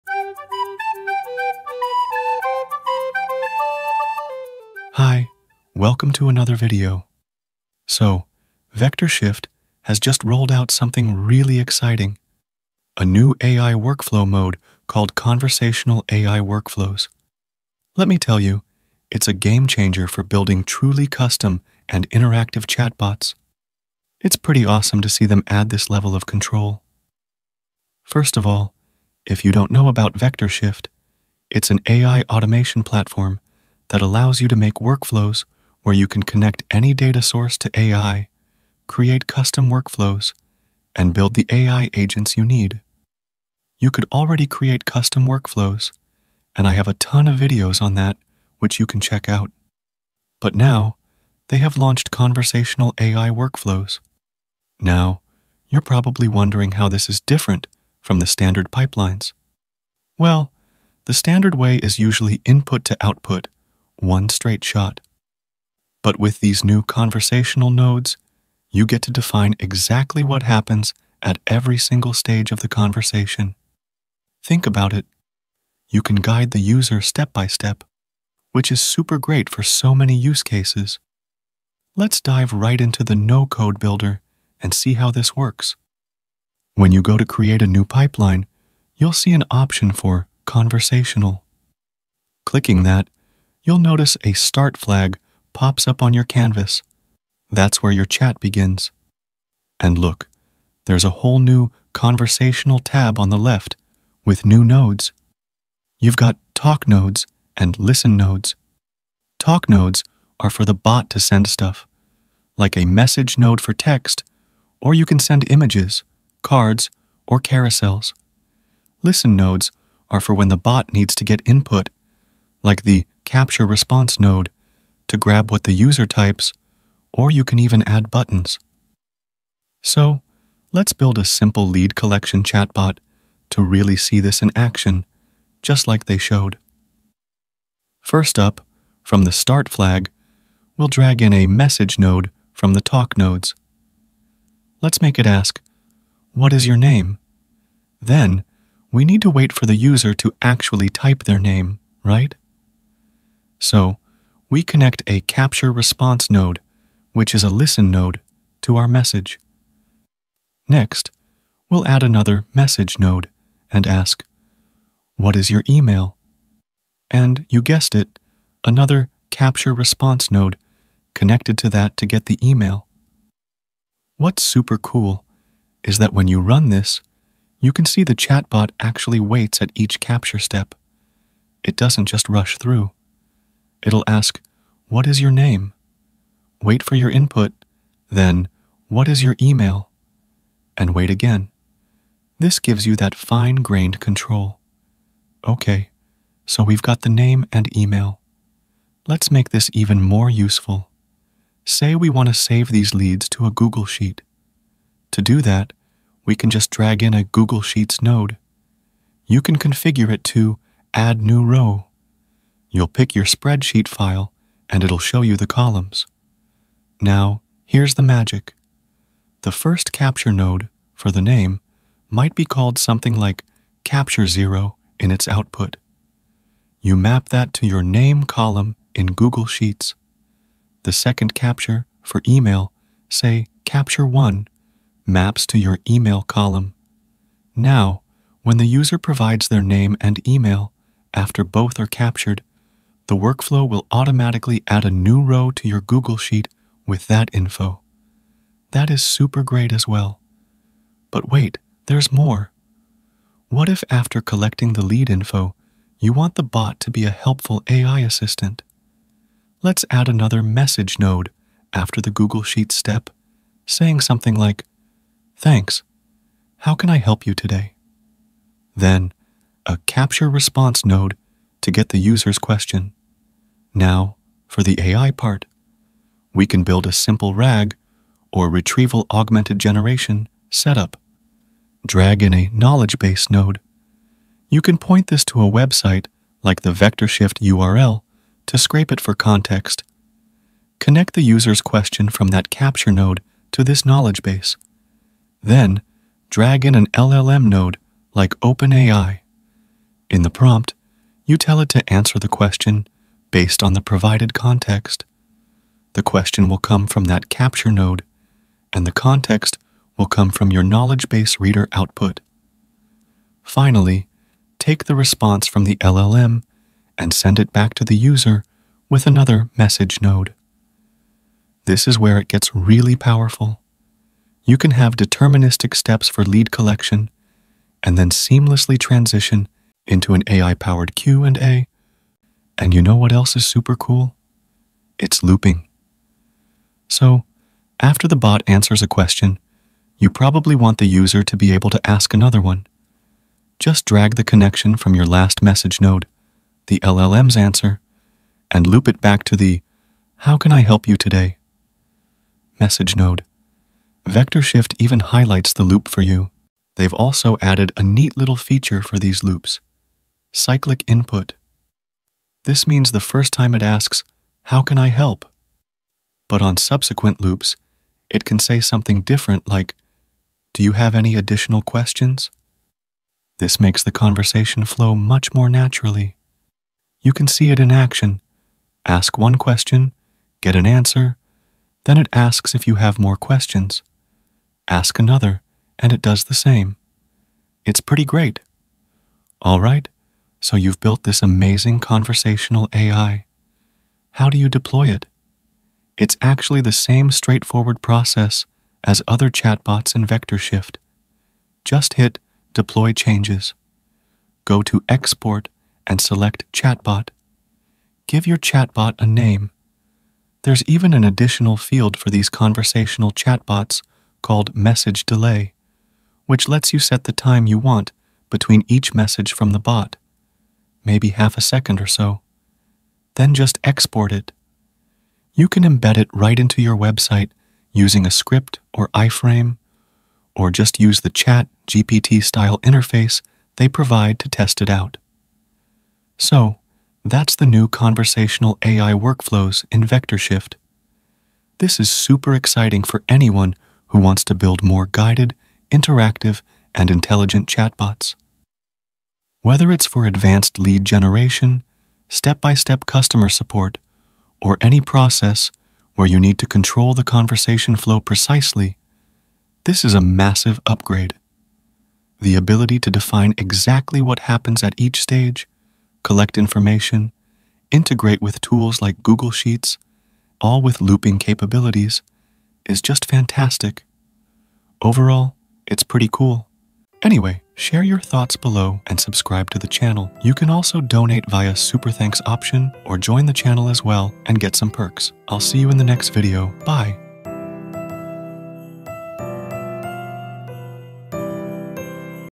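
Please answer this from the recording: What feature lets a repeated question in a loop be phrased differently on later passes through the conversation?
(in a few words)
cyclic input.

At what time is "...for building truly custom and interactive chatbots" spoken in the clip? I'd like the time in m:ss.
0:20.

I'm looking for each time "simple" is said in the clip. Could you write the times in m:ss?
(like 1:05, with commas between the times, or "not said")
2:11, 4:36.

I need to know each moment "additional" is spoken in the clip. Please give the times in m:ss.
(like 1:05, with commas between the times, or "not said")
6:11, 6:51.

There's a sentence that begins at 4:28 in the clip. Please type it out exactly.
Then, a capture response node to get the user's question.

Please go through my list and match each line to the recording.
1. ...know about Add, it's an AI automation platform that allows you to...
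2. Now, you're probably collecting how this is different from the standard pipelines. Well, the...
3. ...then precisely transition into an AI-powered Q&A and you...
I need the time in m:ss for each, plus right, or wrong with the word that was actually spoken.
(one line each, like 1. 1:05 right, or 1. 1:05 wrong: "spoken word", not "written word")
1. 0:29 wrong: "VectorShift", not "Add"
2. 0:54 wrong: "wondering", not "collecting"
3. 5:27 wrong: "seamlessly", not "precisely".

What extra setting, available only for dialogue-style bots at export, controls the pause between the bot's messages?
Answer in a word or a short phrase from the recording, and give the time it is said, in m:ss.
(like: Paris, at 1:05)
Message Delay, at 6:54.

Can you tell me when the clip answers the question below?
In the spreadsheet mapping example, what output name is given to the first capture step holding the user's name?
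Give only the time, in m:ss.
3:43.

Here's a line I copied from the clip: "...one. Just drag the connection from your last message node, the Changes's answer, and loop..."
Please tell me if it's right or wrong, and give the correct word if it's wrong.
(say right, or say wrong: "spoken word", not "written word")
wrong: "LLM", not "Changes".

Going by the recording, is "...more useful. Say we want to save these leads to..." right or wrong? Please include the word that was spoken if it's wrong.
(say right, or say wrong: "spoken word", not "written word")
right.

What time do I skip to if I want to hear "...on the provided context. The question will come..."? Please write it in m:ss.
5:03.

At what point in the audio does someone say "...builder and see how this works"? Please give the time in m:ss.
1:23.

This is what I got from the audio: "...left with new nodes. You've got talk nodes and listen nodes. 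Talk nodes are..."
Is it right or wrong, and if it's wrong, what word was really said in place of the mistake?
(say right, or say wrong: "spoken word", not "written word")
right.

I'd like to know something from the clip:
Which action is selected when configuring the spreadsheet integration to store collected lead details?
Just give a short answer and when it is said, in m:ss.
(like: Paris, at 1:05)
Add New Row, at 3:30.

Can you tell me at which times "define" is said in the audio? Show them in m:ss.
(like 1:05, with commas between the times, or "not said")
1:09, 7:42.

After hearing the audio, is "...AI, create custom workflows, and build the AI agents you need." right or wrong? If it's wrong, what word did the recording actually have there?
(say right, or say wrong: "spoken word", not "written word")
right.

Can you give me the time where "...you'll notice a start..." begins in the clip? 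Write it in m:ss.
1:33.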